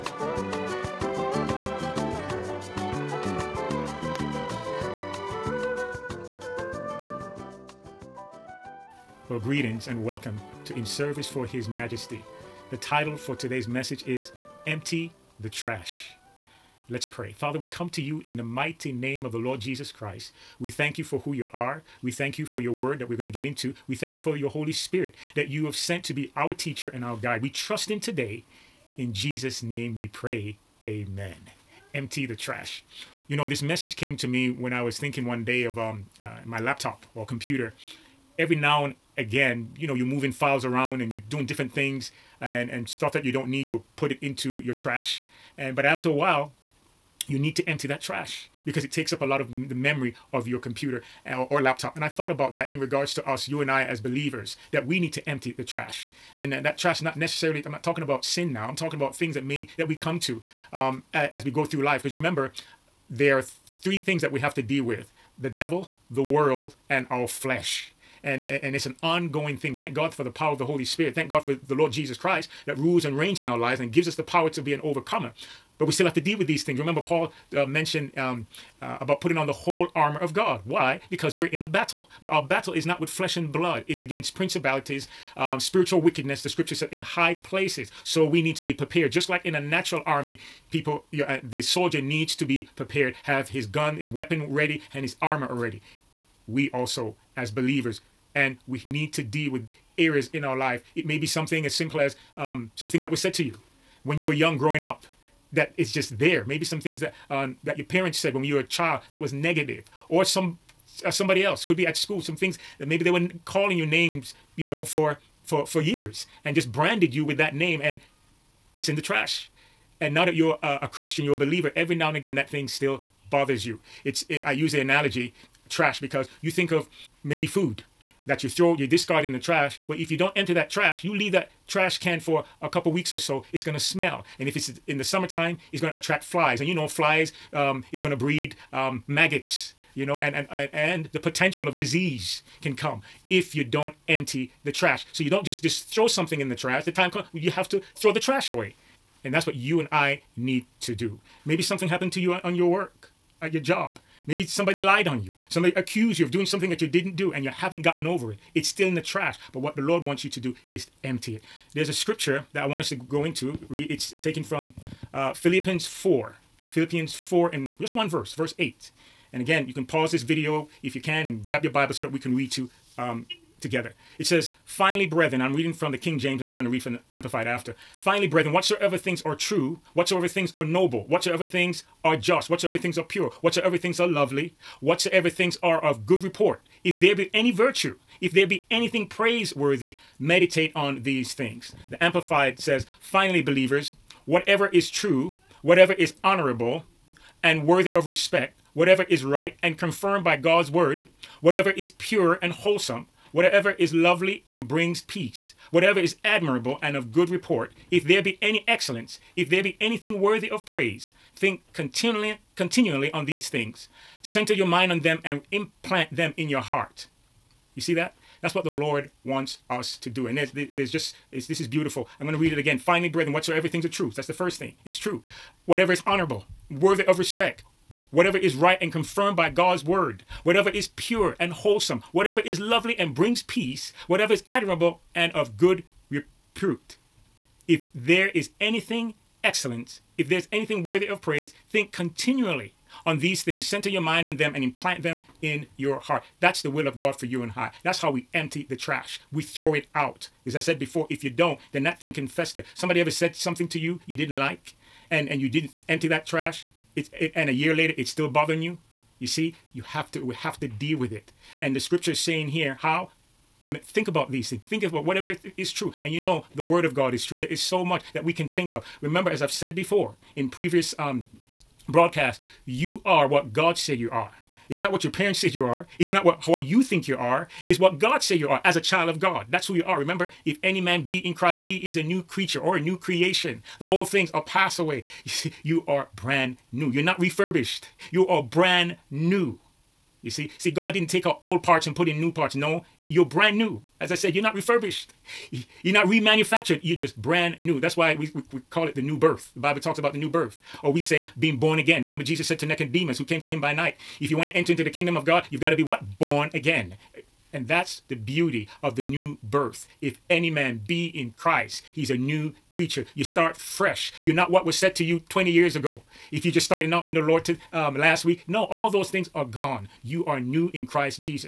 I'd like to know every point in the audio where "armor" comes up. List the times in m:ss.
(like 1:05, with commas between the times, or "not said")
1:19, 1:35.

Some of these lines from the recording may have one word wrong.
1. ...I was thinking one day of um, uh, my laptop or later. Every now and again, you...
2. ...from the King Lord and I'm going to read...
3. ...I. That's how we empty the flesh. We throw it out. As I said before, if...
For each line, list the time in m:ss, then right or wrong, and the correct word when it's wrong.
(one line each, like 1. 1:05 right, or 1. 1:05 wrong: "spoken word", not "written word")
1. 0:34 wrong: "computer", not "later"
2. 2:55 wrong: "James", not "Lord"
3. 4:07 wrong: "trash", not "flesh".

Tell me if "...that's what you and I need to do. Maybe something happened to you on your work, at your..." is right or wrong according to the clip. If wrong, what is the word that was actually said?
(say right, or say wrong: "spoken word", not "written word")
right.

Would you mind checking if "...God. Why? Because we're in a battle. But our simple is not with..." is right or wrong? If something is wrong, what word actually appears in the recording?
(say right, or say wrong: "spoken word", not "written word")
wrong: "battle", not "simple".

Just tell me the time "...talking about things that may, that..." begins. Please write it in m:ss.
0:58.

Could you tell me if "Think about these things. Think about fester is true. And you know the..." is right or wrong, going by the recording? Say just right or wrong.
wrong.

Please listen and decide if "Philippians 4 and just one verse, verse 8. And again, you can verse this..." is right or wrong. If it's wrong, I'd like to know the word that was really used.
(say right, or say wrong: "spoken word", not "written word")
wrong: "pause", not "verse".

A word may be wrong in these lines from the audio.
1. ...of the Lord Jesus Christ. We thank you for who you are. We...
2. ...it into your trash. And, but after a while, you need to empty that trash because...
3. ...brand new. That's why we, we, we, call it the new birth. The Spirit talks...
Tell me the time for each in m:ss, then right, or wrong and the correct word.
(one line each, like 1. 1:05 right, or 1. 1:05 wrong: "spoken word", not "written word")
1. 0:19 right
2. 0:44 right
3. 4:57 wrong: "Bible", not "Spirit".